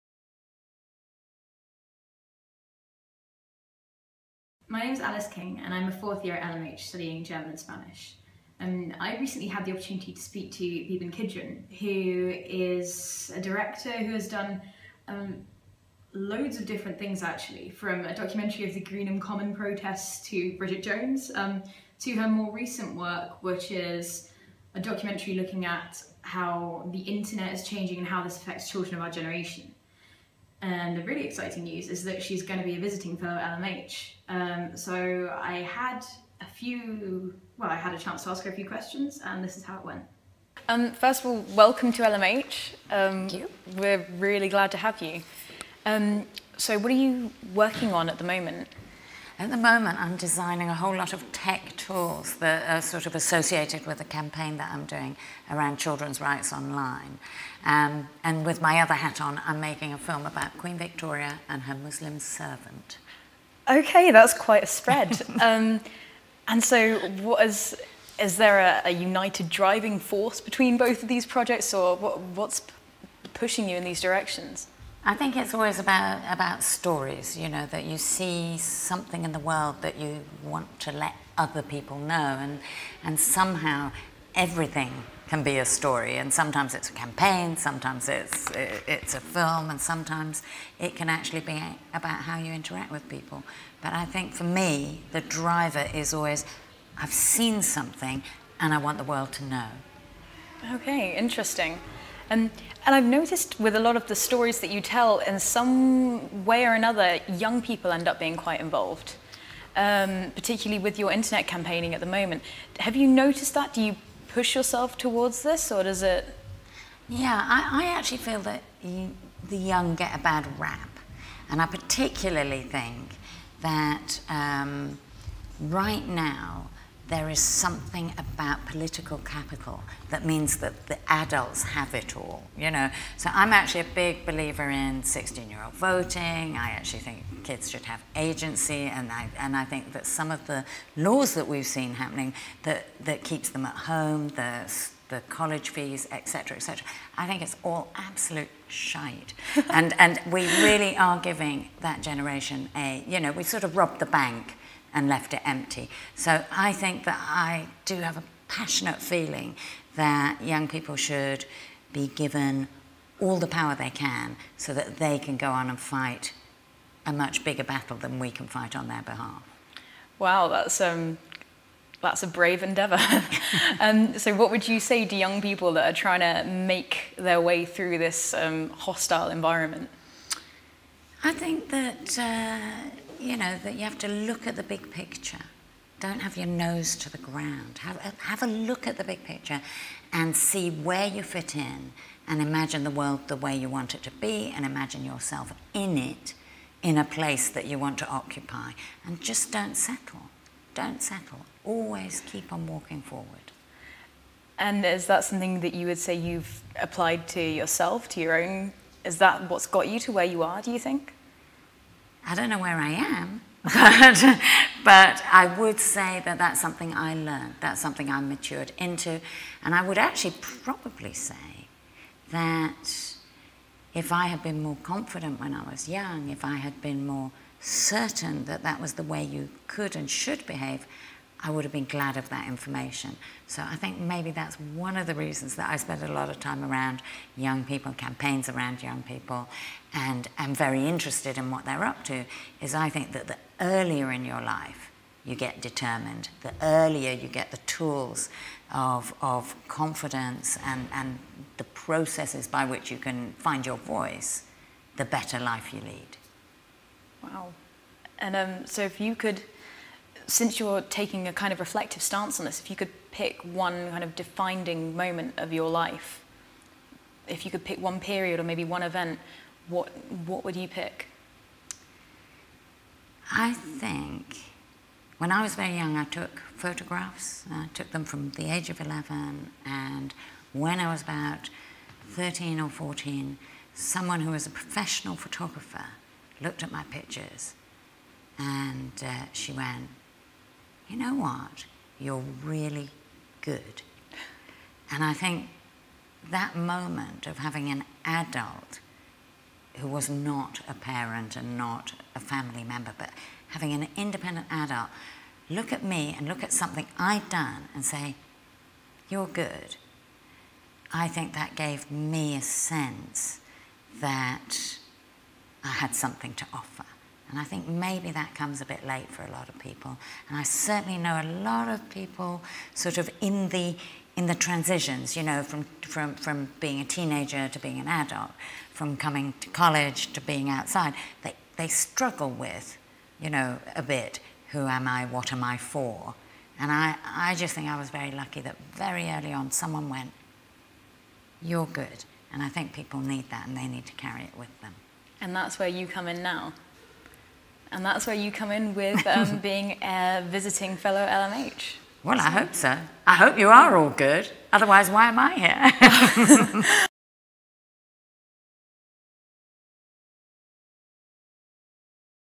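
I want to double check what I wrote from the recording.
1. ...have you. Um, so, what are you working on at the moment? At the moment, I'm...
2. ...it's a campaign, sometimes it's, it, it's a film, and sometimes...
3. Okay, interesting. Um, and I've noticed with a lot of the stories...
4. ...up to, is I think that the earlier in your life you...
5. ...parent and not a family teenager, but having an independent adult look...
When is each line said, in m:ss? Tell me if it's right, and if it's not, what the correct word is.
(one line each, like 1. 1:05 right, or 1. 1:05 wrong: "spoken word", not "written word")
1. 0:44 right
2. 1:26 right
3. 1:40 right
4. 4:01 right
5. 5:00 wrong: "member", not "teenager".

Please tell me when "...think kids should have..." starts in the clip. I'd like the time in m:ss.
2:17.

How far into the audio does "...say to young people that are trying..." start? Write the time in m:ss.
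2:54.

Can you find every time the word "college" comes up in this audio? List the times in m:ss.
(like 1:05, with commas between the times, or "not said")
2:25, 5:29.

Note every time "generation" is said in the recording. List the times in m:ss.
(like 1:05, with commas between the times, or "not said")
0:29, 2:32.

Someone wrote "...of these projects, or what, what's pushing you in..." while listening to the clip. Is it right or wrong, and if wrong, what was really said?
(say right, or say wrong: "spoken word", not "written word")
right.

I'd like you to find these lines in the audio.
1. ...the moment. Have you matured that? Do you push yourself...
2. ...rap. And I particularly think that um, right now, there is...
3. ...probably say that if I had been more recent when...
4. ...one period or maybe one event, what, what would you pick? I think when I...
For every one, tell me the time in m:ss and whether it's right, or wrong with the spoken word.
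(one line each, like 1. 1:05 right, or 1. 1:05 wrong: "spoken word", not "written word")
1. 1:51 wrong: "noticed", not "matured"
2. 2:00 right
3. 3:40 wrong: "confident", not "recent"
4. 4:27 right.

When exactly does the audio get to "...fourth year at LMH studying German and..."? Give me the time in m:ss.
0:05.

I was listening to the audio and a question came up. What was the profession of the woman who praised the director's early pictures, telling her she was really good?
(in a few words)
professional photographer.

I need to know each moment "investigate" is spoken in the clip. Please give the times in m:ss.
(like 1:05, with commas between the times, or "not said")
not said.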